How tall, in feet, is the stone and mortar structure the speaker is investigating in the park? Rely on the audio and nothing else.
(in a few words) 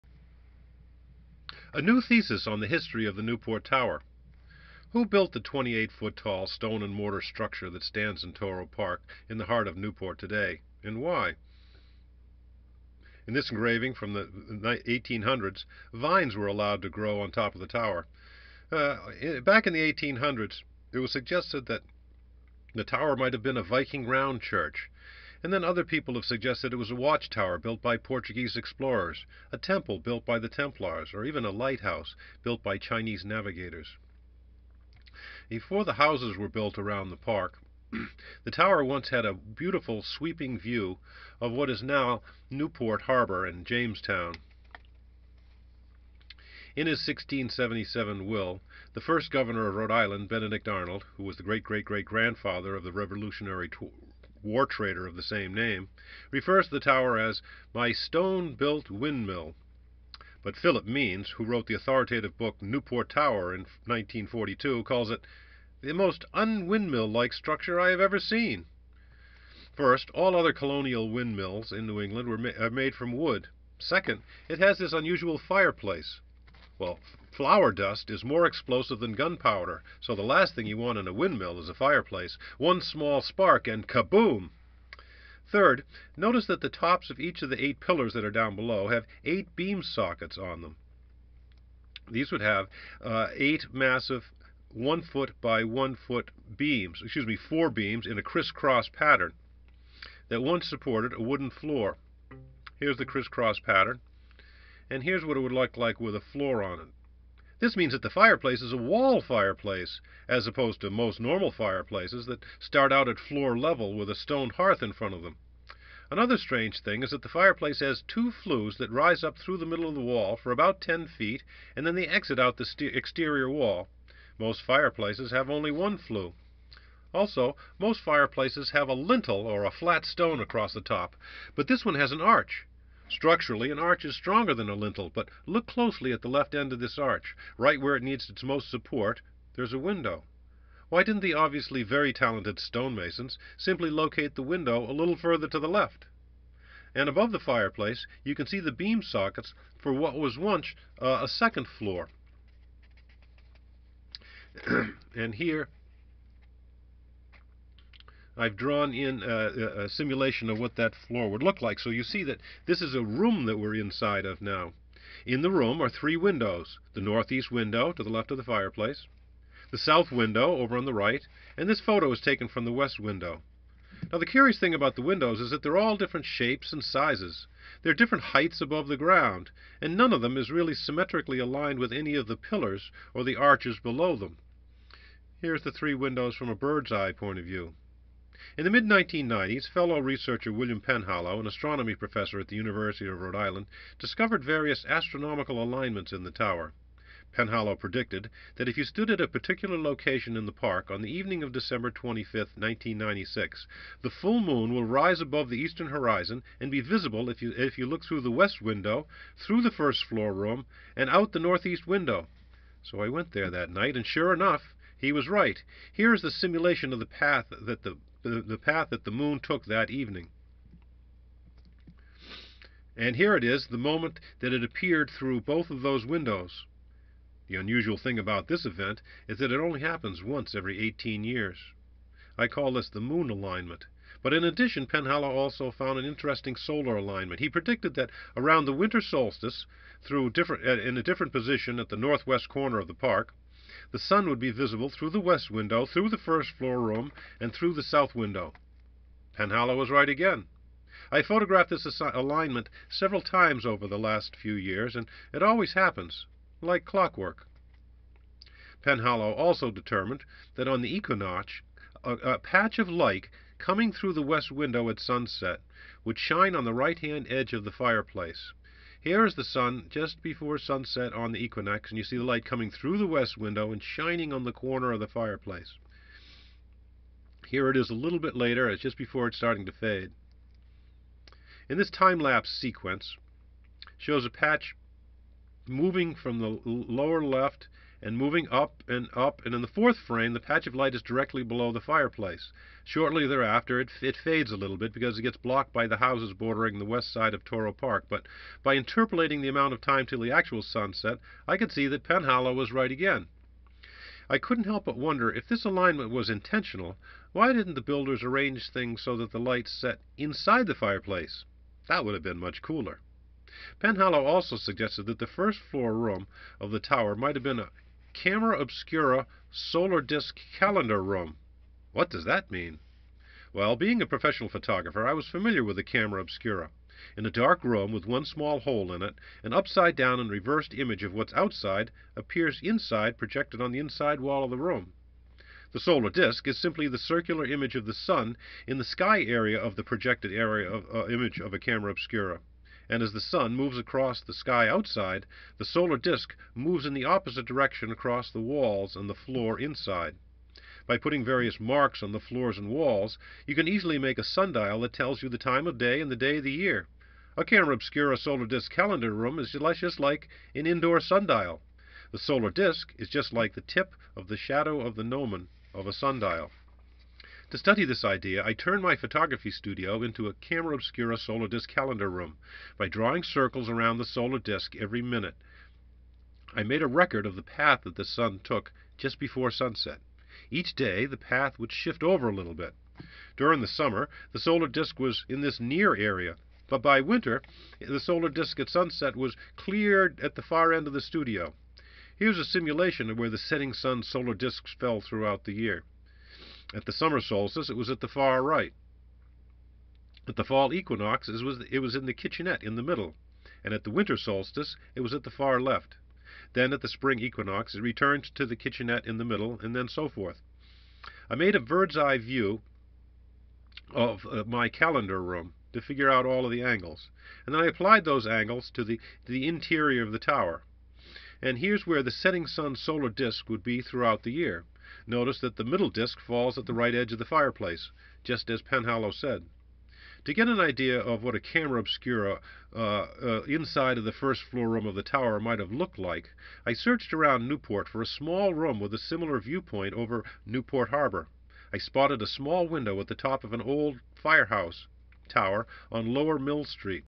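28.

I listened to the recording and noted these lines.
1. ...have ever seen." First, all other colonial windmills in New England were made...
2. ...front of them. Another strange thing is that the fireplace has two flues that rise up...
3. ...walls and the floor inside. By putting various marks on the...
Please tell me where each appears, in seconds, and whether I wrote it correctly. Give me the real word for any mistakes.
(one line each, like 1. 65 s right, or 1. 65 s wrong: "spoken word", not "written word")
1. 67 s right
2. 114 s right
3. 348 s right.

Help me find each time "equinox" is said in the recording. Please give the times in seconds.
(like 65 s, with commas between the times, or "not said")
260 s, 271 s, 400 s, 407 s.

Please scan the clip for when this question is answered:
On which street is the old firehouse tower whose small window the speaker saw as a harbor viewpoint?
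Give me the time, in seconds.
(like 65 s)
446 s.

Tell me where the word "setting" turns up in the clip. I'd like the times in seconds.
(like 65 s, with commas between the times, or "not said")
393 s, 422 s.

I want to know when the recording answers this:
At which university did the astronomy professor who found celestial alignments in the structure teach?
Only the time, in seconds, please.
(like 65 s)
192 s.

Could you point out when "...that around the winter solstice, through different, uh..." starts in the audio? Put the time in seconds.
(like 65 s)
237 s.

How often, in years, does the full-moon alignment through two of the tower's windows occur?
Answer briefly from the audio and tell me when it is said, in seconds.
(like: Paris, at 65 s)
Every 18 years, at 230 s.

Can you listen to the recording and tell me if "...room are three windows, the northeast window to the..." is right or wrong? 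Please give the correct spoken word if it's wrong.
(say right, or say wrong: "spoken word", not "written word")
right.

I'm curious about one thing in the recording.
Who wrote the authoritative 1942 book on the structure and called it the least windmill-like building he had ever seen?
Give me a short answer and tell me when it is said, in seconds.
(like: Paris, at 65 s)
Philip Means, at 60 s.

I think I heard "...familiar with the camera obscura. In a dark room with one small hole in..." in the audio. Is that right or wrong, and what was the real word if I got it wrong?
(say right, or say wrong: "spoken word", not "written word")
right.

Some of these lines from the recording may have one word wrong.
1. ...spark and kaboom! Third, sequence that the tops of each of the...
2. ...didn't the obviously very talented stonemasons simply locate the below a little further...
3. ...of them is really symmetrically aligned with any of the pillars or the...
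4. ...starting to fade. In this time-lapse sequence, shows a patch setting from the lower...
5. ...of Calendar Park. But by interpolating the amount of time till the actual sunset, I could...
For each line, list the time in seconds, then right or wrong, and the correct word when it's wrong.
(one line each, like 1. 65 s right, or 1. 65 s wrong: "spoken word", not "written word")
1. 83 s wrong: "notice", not "sequence"
2. 141 s wrong: "window", not "below"
3. 180 s right
4. 279 s wrong: "moving", not "setting"
5. 297 s wrong: "Touro", not "Calendar".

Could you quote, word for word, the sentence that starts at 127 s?
Also, most fireplaces have a lintel or a flat stone across the top, but this one has an arch.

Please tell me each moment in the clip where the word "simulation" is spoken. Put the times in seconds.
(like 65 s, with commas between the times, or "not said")
159 s, 216 s, 392 s.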